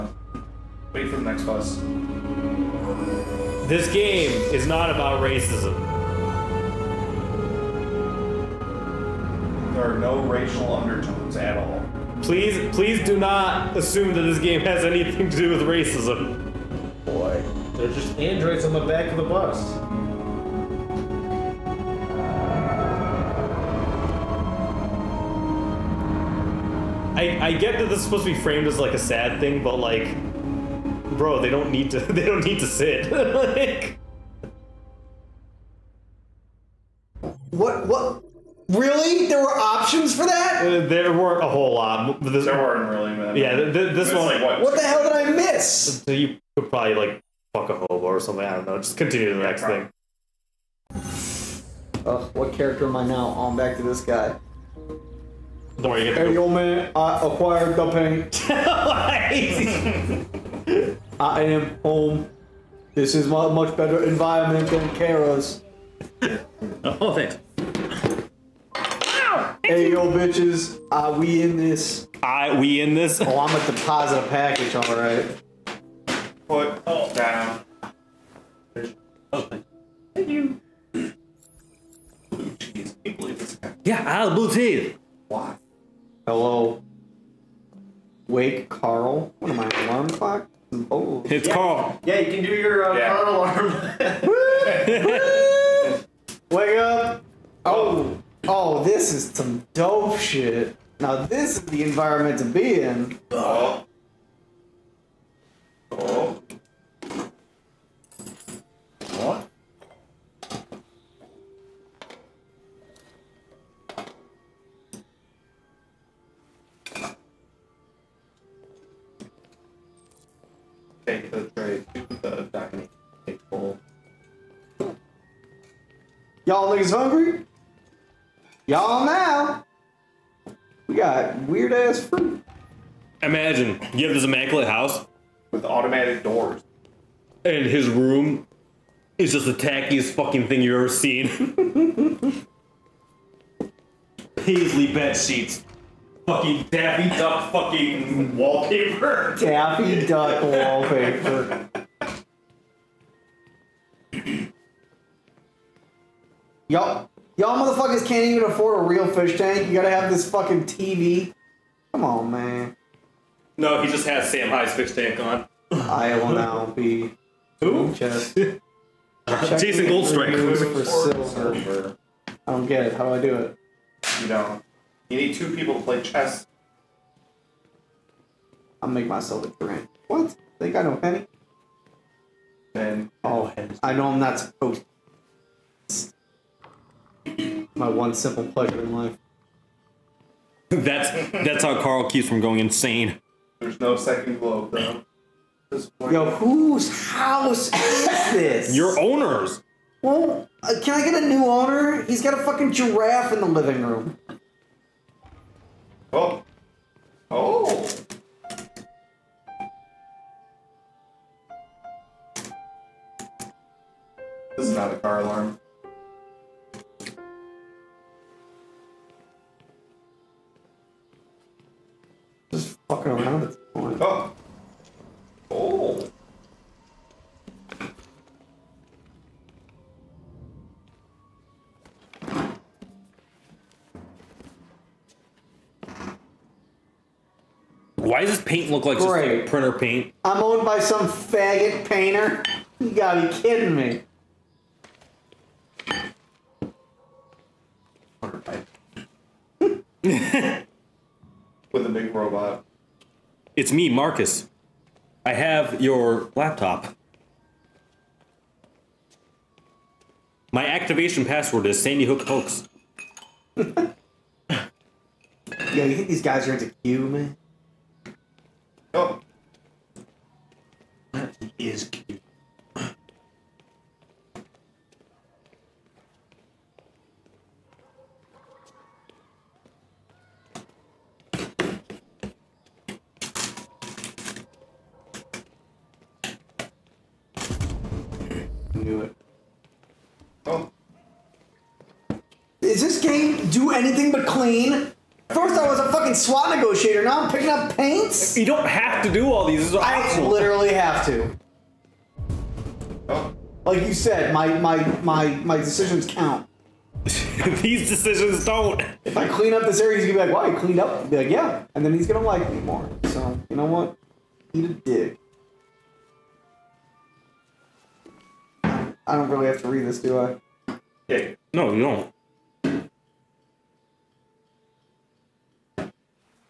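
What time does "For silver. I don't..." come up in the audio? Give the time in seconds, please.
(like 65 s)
170 s.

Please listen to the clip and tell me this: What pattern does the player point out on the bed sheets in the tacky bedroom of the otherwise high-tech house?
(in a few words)
Paisley.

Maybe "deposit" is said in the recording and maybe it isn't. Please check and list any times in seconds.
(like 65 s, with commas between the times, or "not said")
73 s.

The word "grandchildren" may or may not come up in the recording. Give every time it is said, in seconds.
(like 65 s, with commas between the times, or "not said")
not said.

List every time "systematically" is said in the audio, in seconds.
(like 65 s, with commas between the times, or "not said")
not said.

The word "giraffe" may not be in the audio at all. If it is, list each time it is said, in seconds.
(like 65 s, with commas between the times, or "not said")
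202 s.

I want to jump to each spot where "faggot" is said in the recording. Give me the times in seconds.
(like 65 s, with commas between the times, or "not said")
241 s.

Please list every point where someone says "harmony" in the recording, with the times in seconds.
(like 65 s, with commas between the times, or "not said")
not said.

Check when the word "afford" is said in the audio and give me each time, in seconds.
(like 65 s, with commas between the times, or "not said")
158 s.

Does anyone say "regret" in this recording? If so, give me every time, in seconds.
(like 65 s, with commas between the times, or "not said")
not said.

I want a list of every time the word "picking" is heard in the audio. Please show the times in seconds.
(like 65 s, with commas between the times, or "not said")
297 s.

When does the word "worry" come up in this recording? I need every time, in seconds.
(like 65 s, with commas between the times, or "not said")
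55 s.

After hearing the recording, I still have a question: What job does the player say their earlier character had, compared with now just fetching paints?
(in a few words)
SWAT negotiator.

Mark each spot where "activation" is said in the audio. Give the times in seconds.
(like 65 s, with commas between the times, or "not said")
260 s.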